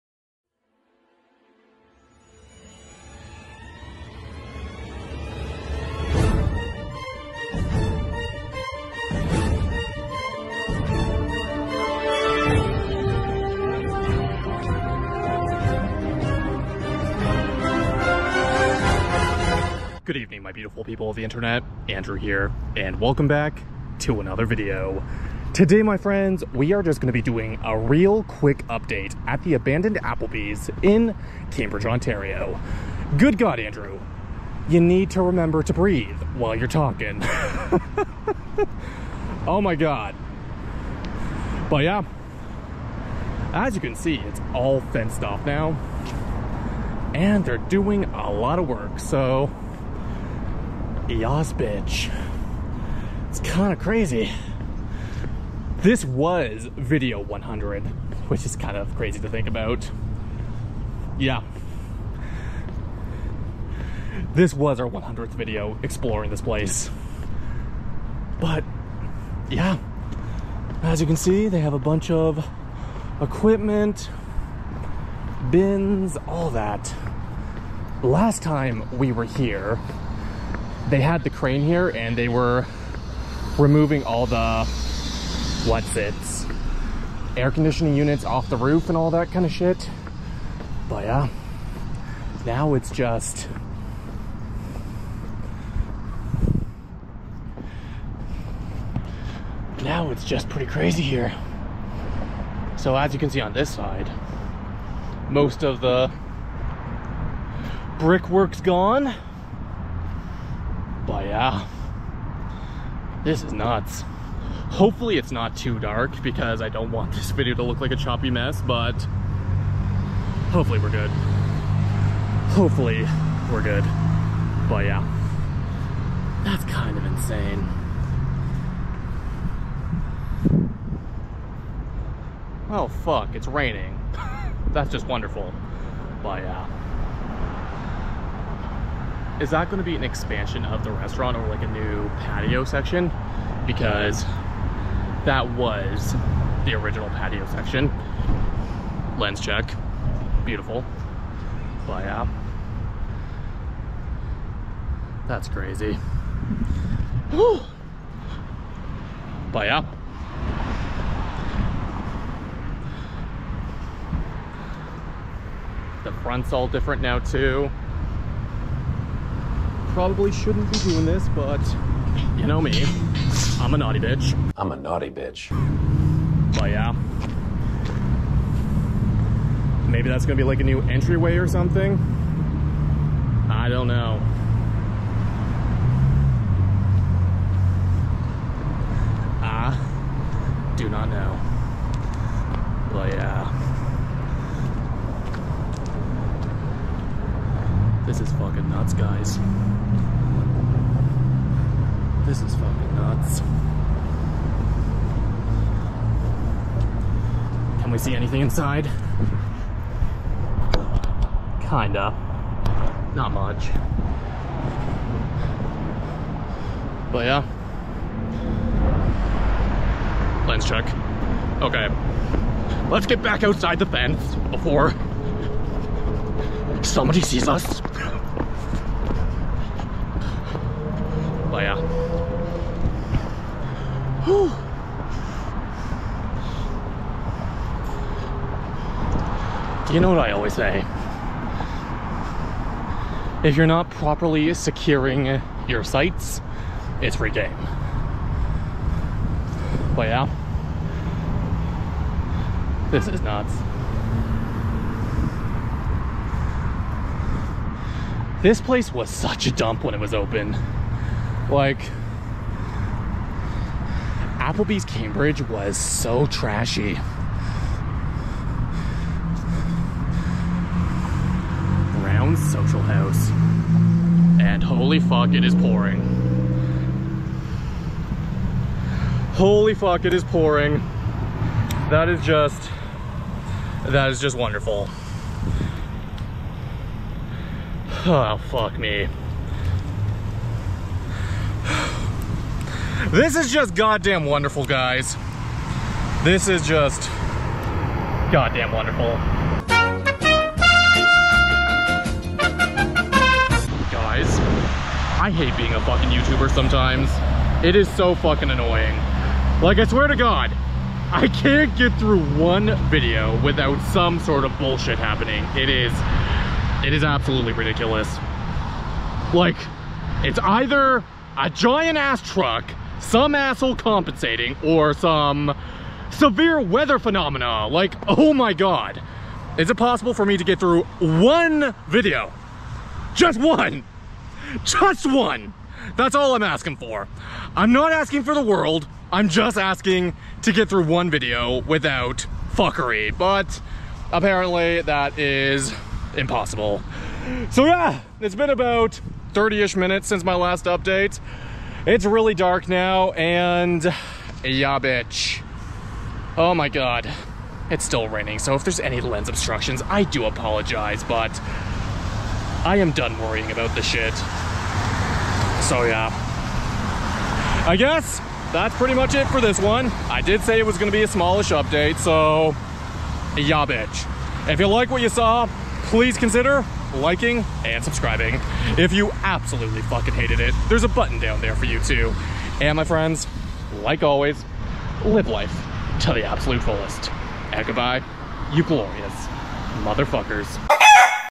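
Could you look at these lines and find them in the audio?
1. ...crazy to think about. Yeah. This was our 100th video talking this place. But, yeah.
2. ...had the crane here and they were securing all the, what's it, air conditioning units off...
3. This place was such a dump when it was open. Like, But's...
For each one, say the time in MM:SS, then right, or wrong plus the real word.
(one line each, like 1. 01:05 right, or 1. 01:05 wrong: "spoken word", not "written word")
1. 00:58 wrong: "exploring", not "talking"
2. 01:20 wrong: "removing", not "securing"
3. 04:18 wrong: "Applebee", not "But".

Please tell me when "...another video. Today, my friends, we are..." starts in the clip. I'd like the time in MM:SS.
00:24.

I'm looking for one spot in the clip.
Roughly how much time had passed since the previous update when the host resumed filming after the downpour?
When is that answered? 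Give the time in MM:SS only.
05:49.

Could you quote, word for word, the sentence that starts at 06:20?
There's a button down there for you too.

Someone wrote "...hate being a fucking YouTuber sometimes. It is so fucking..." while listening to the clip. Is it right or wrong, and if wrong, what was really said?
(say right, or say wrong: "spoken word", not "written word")
right.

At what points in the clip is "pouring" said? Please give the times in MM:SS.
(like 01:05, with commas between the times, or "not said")
04:35, 04:40.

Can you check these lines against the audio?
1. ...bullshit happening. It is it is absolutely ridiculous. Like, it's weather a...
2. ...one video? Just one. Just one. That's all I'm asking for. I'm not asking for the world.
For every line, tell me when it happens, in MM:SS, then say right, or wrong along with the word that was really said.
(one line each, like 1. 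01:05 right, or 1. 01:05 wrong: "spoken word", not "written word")
1. 05:14 wrong: "either", not "weather"
2. 05:30 right.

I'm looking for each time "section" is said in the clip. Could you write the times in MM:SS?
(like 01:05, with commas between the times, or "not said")
02:22, 02:27.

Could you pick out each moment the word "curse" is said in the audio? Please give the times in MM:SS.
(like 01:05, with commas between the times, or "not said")
not said.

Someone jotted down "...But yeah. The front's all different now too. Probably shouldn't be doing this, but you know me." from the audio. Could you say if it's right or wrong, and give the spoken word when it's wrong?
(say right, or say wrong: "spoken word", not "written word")
right.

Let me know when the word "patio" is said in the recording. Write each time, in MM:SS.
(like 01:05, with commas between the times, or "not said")
02:22, 02:27.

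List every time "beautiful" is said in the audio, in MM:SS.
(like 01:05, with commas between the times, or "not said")
00:20, 02:30.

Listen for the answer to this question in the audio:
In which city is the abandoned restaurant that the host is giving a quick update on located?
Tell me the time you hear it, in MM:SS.
00:31.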